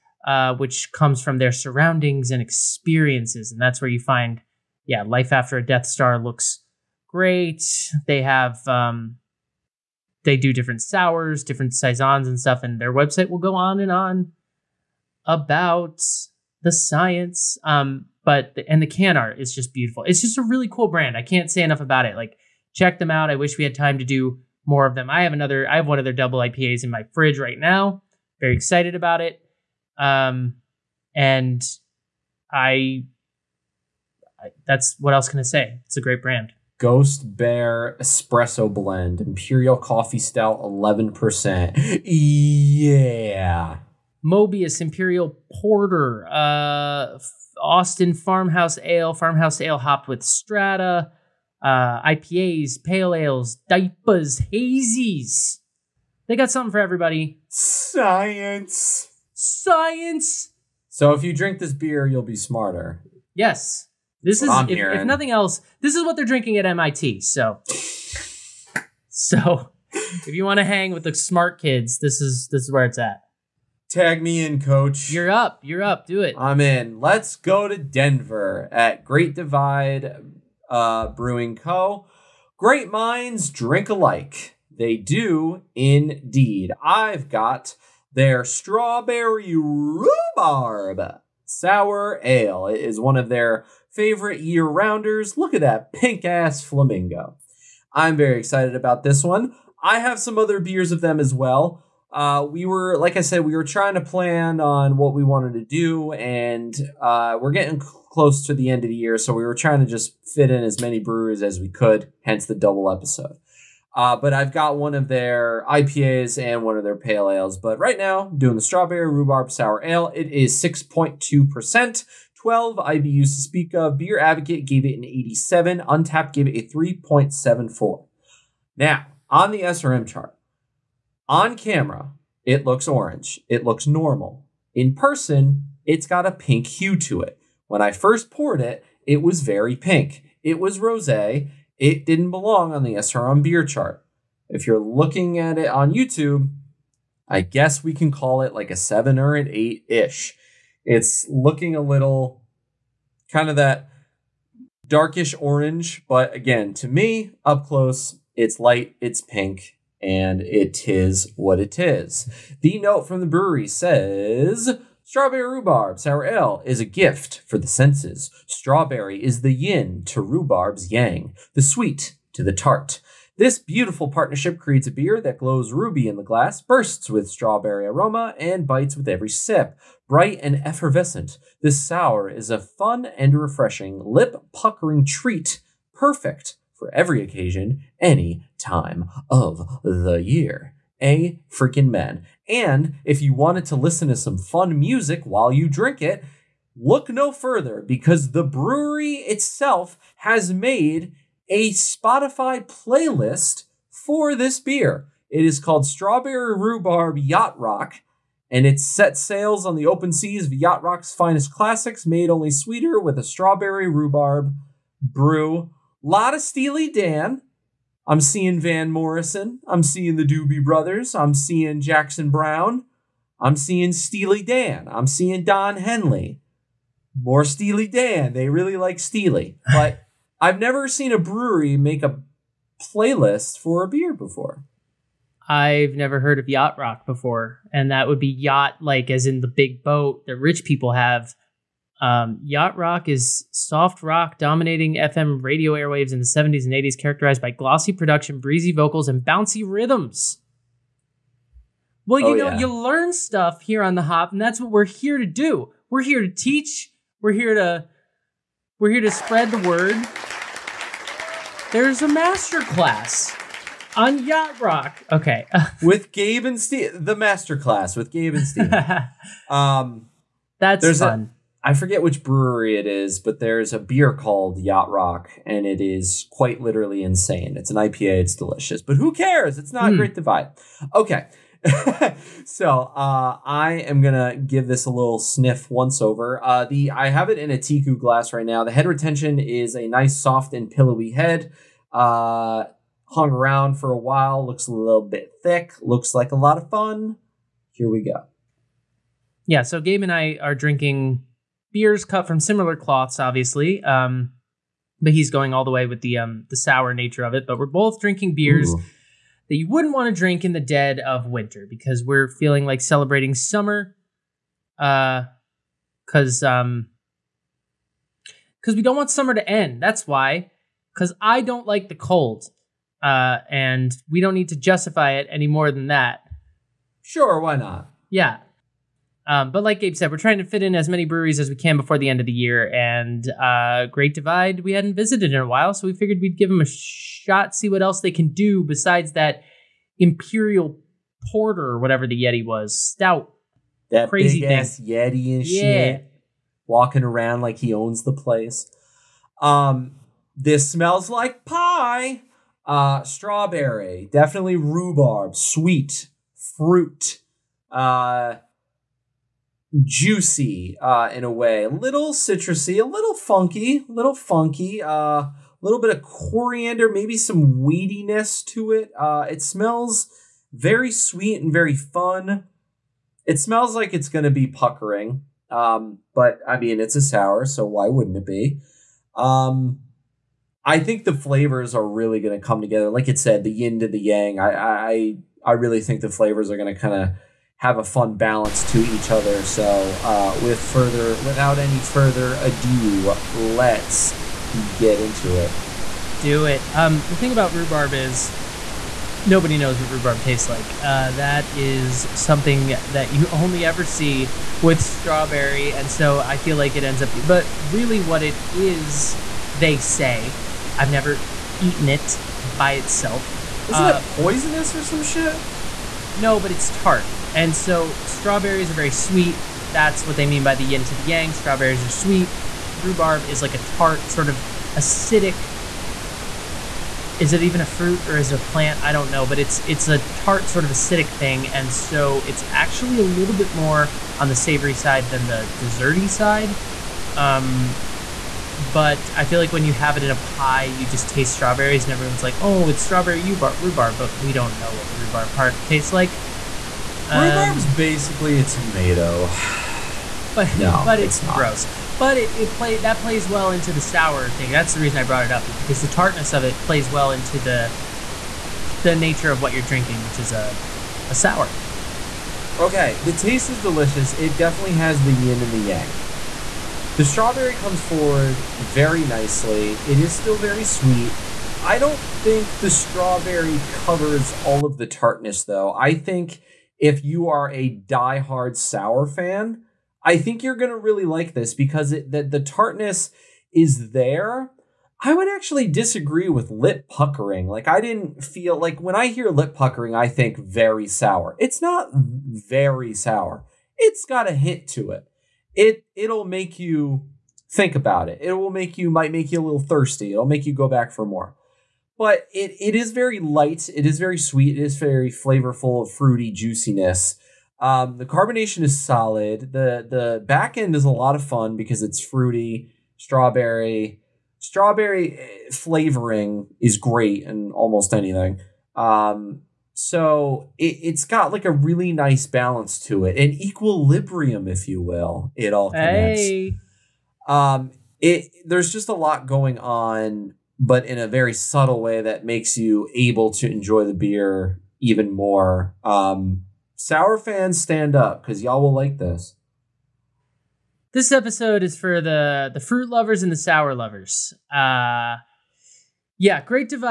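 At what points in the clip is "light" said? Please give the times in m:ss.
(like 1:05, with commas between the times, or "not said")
2:38, 8:23.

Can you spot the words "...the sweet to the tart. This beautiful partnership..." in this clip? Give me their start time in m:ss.
2:51.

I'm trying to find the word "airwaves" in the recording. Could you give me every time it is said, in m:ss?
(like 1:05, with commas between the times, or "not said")
4:05.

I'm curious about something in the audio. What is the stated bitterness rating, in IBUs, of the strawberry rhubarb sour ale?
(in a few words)
12.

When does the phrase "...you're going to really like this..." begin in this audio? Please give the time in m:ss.
8:00.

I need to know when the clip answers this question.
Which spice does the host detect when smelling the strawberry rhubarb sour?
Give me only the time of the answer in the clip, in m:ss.
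6:06.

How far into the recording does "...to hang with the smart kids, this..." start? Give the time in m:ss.
1:10.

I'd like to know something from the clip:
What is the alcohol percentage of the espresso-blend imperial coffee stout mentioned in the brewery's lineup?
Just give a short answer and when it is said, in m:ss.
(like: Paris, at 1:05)
11%, at 0:40.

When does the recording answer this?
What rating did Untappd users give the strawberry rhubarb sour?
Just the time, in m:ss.
2:06.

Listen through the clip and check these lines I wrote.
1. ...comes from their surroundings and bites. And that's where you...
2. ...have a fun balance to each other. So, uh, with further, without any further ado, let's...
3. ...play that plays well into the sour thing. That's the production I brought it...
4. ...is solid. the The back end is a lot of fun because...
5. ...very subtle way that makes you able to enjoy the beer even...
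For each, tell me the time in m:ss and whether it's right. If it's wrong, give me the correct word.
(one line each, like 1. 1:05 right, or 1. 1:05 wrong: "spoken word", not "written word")
1. 0:00 wrong: "experiences", not "bites"
2. 6:27 right
3. 7:32 wrong: "reason", not "production"
4. 8:28 right
5. 8:51 right.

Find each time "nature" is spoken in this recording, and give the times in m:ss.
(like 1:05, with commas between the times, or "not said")
5:06, 7:38.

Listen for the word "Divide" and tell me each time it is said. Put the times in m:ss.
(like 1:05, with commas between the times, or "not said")
1:19, 4:40, 5:34.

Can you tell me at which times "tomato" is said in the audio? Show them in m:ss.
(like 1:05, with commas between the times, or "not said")
7:28.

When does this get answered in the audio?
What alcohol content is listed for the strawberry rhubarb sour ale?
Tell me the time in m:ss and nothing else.
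2:00.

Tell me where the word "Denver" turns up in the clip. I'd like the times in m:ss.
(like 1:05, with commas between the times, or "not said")
1:17.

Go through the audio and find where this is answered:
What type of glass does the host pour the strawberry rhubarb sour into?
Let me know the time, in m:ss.
4:47.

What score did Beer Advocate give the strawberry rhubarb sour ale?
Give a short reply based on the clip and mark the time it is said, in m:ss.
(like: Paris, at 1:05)
87, at 2:05.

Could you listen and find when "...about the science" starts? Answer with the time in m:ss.
0:15.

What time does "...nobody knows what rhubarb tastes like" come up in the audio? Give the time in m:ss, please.
6:39.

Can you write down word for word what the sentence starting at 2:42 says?
The note from the brewery says Strawberry rhubarb sour ale is a gift for the senses.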